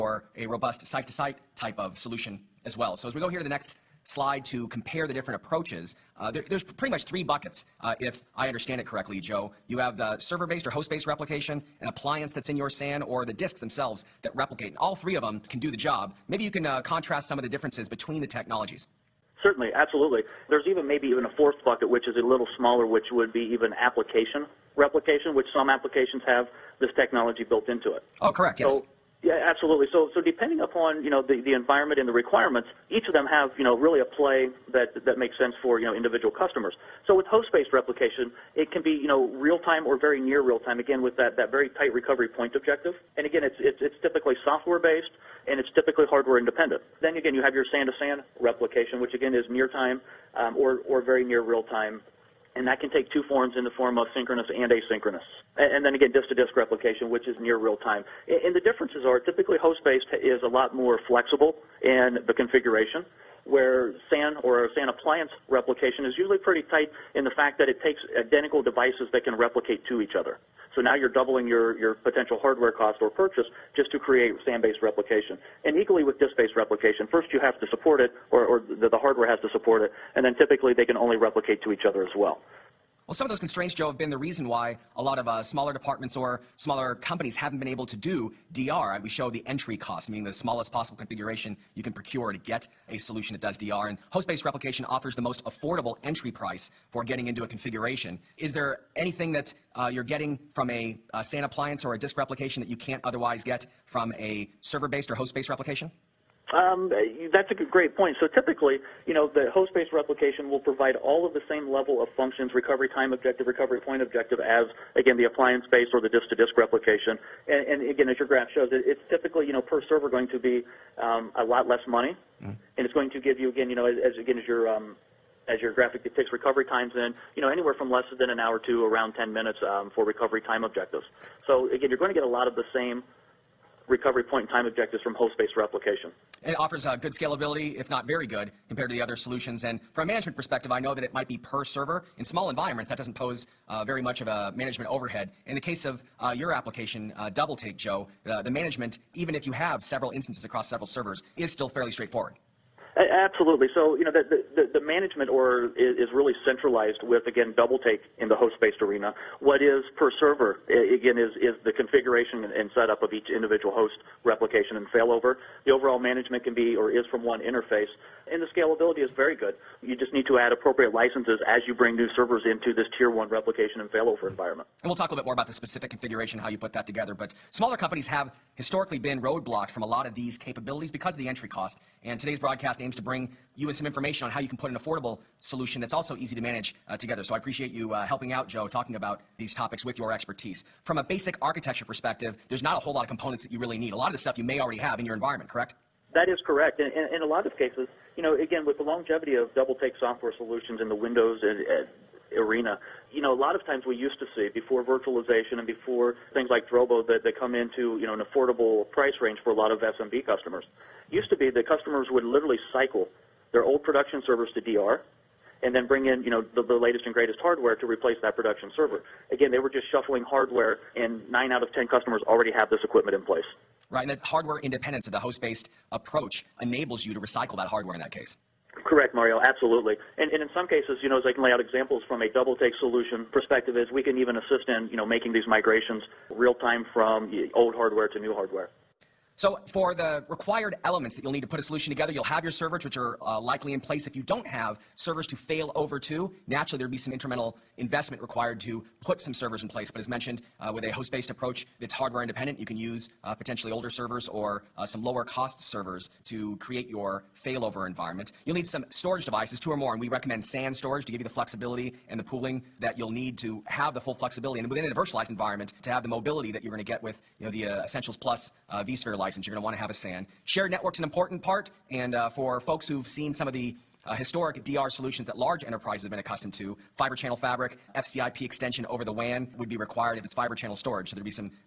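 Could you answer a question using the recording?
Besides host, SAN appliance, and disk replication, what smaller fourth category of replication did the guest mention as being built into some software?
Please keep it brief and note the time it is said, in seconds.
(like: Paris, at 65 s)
application replication, at 23 s.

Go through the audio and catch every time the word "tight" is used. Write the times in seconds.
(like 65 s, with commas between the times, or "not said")
41 s, 66 s.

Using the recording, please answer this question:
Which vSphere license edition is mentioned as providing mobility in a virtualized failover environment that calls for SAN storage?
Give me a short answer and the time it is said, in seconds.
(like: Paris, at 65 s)
Essentials Plus, at 267 s.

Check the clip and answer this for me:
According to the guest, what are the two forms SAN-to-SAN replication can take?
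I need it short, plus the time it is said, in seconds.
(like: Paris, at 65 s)
synchronous and asynchronous, at 54 s.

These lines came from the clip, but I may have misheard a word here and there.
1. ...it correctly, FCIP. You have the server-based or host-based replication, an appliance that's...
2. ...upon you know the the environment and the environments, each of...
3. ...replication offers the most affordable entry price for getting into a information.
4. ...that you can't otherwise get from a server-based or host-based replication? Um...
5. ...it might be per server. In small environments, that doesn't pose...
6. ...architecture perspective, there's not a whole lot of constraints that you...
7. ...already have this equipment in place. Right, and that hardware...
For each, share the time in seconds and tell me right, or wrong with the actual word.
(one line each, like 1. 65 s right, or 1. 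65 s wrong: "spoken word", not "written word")
1. 8 s wrong: "Joe", not "FCIP"
2. 30 s wrong: "requirements", not "environments"
3. 94 s wrong: "configuration", not "information"
4. 102 s right
5. 141 s right
6. 191 s wrong: "components", not "constraints"
7. 222 s right.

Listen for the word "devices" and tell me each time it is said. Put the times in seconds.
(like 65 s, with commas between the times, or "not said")
68 s, 259 s.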